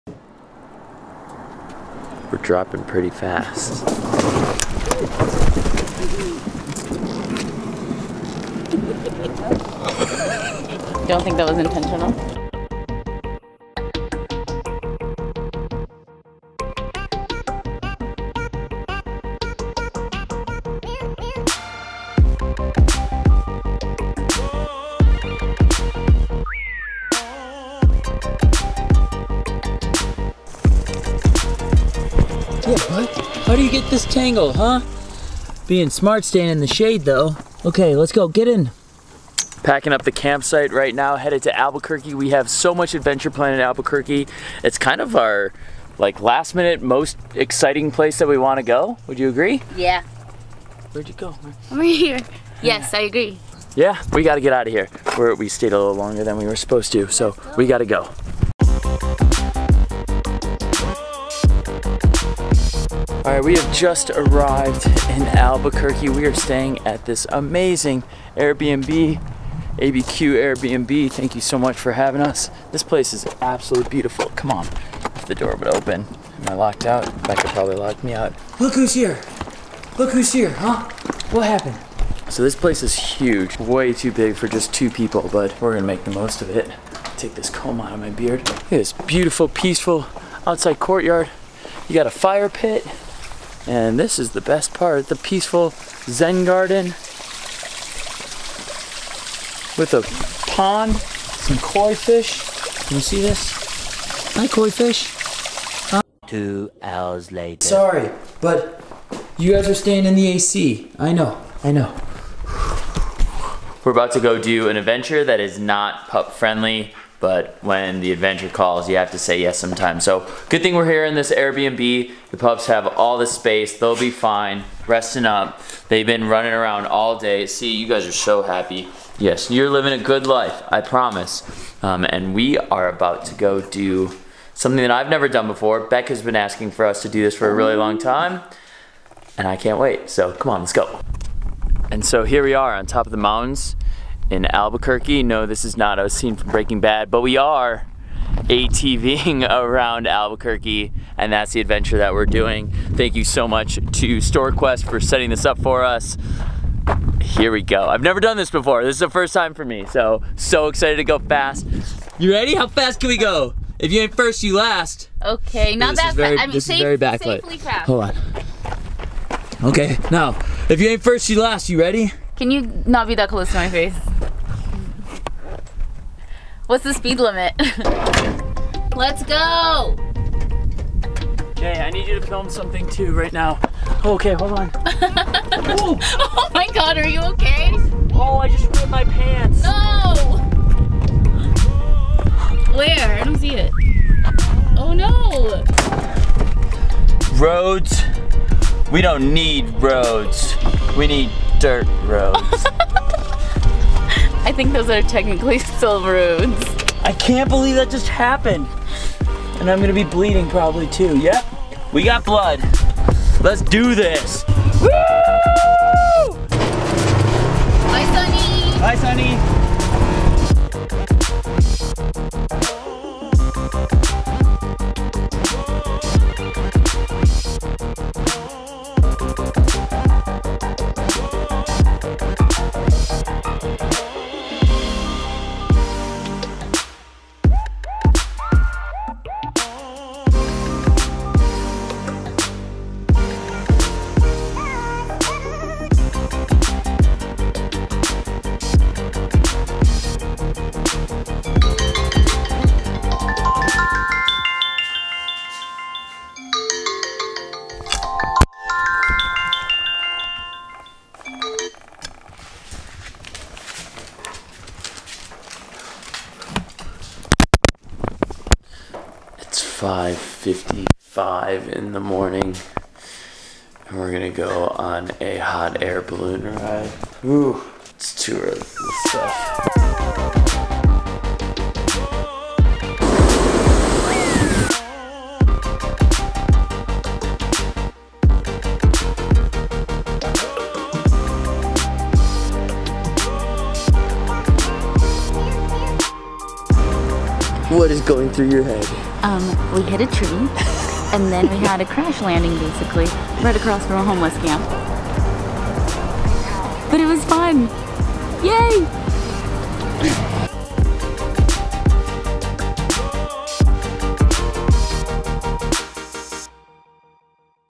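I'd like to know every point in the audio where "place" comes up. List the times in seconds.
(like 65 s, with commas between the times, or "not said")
47 s, 72 s, 82 s.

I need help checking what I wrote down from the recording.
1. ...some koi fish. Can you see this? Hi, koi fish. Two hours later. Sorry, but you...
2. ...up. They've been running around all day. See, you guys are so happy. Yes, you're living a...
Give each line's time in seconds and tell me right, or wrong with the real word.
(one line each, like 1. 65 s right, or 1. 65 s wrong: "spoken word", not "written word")
1. 100 s right
2. 125 s right.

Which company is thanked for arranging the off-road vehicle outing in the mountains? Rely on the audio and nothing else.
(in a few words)
StorQuest.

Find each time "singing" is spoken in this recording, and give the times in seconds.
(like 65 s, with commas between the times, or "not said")
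not said.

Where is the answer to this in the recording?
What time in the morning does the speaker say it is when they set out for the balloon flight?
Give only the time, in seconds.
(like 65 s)
269 s.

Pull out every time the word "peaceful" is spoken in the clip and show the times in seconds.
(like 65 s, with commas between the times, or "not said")
89 s, 95 s.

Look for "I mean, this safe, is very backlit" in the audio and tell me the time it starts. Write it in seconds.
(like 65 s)
166 s.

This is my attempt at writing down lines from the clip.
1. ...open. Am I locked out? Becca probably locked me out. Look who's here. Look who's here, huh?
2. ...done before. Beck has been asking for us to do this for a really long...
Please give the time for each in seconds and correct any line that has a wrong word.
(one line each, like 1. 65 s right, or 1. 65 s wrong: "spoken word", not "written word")
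1. 75 s right
2. 135 s right.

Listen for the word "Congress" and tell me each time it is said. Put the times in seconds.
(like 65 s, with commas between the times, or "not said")
not said.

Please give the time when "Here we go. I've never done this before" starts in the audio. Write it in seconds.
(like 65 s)
157 s.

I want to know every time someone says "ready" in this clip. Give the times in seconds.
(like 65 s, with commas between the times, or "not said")
162 s, 171 s.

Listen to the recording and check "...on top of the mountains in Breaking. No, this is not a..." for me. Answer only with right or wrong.
wrong.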